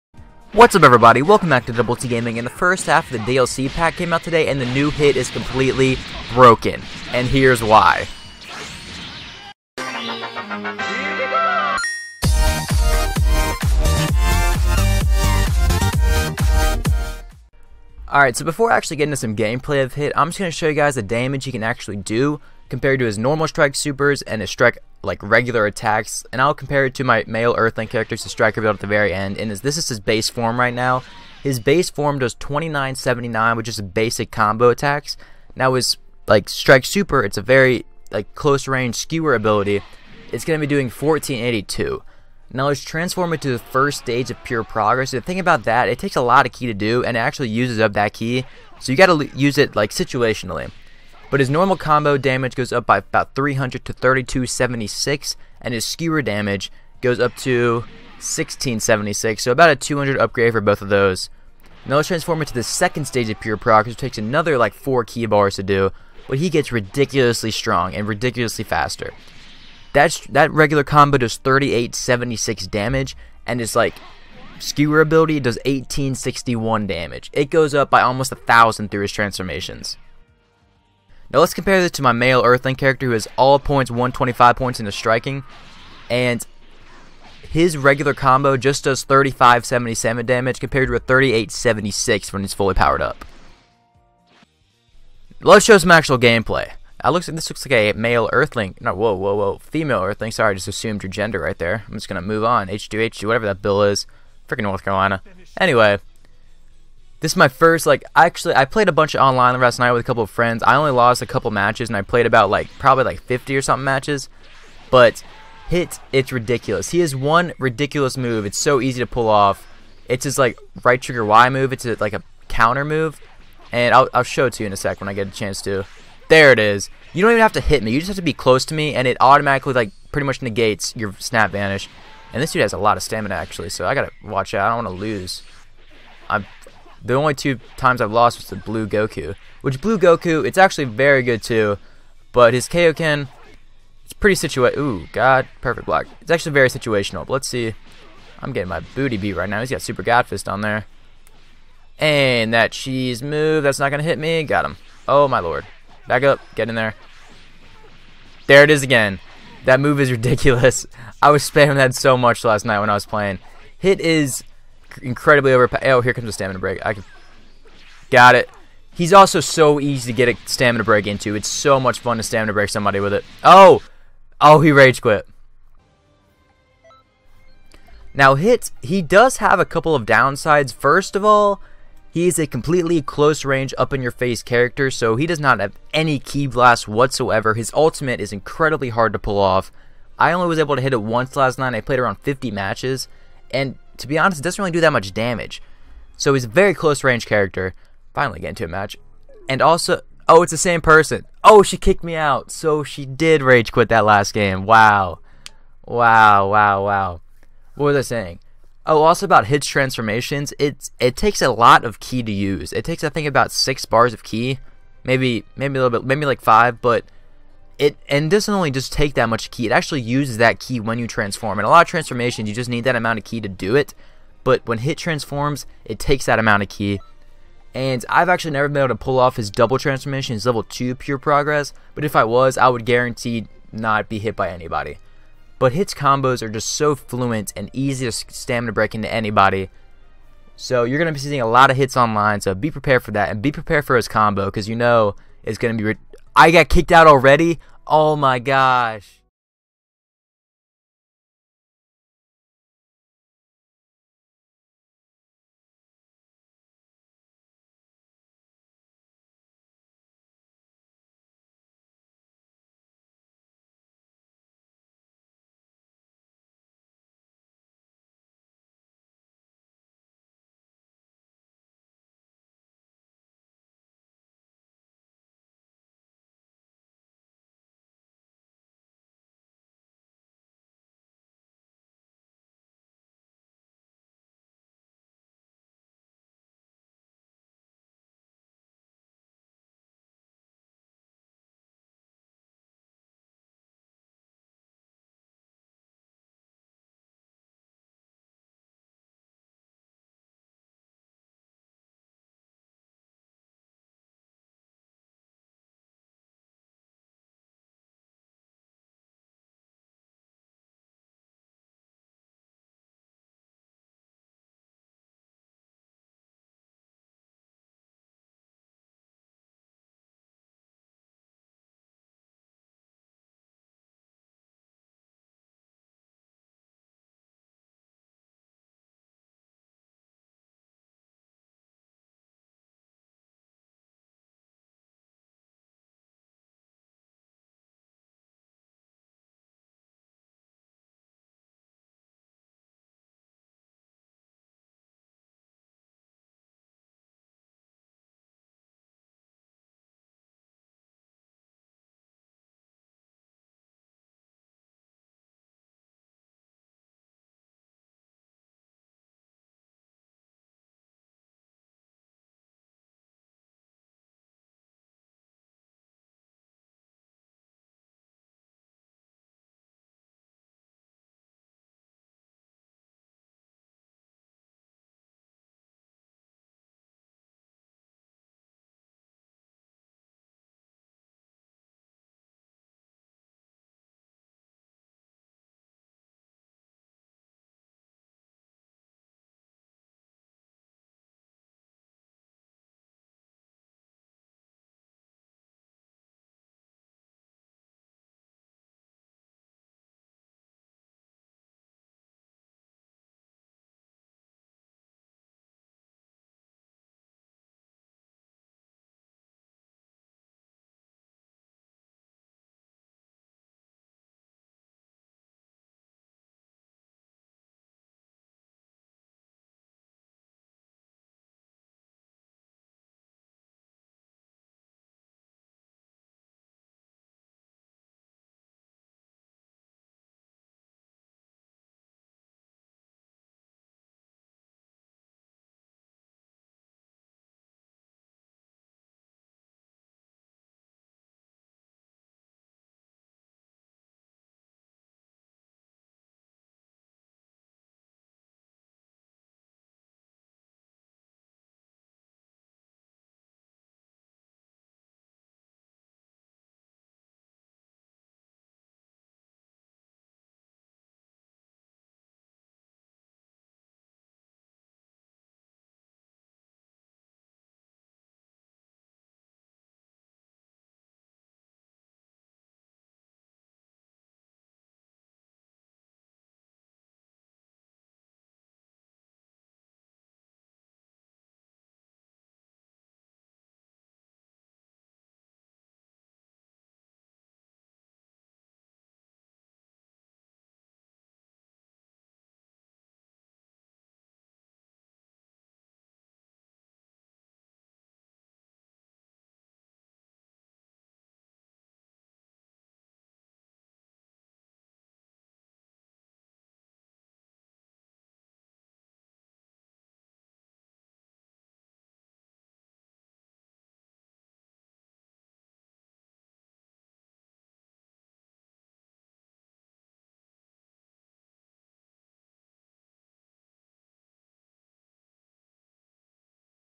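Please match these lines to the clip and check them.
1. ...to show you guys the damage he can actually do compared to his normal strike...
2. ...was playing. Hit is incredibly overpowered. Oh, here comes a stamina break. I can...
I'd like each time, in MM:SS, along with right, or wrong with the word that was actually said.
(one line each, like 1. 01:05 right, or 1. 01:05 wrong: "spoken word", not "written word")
1. 00:20 right
2. 02:42 right.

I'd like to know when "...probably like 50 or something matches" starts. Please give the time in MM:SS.
01:52.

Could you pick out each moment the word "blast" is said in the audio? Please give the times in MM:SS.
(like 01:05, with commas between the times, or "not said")
03:06.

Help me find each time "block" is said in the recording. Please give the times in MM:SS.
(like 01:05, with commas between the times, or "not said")
02:25.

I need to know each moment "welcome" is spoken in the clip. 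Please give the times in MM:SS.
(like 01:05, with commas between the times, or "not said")
00:01.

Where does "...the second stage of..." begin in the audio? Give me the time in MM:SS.
01:02.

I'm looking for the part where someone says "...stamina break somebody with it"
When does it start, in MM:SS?
02:52.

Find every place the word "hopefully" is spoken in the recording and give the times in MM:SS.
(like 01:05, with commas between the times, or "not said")
not said.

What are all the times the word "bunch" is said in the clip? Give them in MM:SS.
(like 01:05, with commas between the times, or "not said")
01:48.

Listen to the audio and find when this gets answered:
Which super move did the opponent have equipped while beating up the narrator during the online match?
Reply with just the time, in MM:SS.
02:29.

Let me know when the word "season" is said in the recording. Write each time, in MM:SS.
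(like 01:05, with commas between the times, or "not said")
not said.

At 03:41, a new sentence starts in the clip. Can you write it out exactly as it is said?
And a lot of transformations, you just need that amount of ki to do it.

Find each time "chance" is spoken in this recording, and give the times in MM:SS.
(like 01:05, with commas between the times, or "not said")
02:05.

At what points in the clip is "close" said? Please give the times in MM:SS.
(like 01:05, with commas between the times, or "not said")
00:38, 02:08, 03:03, 03:16.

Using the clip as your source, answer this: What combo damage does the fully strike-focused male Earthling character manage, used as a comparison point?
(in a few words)
3577.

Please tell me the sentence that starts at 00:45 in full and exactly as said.
The thing about that, it takes a lot of ki to do, and it actually uses up that ki.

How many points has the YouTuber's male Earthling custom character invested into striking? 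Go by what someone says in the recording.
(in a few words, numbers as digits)
125.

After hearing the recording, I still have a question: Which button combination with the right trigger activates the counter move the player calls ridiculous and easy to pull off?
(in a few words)
Right trigger Y.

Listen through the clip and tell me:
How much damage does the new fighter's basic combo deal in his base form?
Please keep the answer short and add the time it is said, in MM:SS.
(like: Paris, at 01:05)
2979, at 00:32.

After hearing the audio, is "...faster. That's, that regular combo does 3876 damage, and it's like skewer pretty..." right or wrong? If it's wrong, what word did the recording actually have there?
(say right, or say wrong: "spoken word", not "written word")
wrong: "ability", not "pretty".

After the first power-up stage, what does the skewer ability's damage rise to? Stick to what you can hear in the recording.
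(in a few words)
1676.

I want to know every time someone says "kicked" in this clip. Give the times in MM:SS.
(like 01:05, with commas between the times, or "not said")
03:21, 04:06.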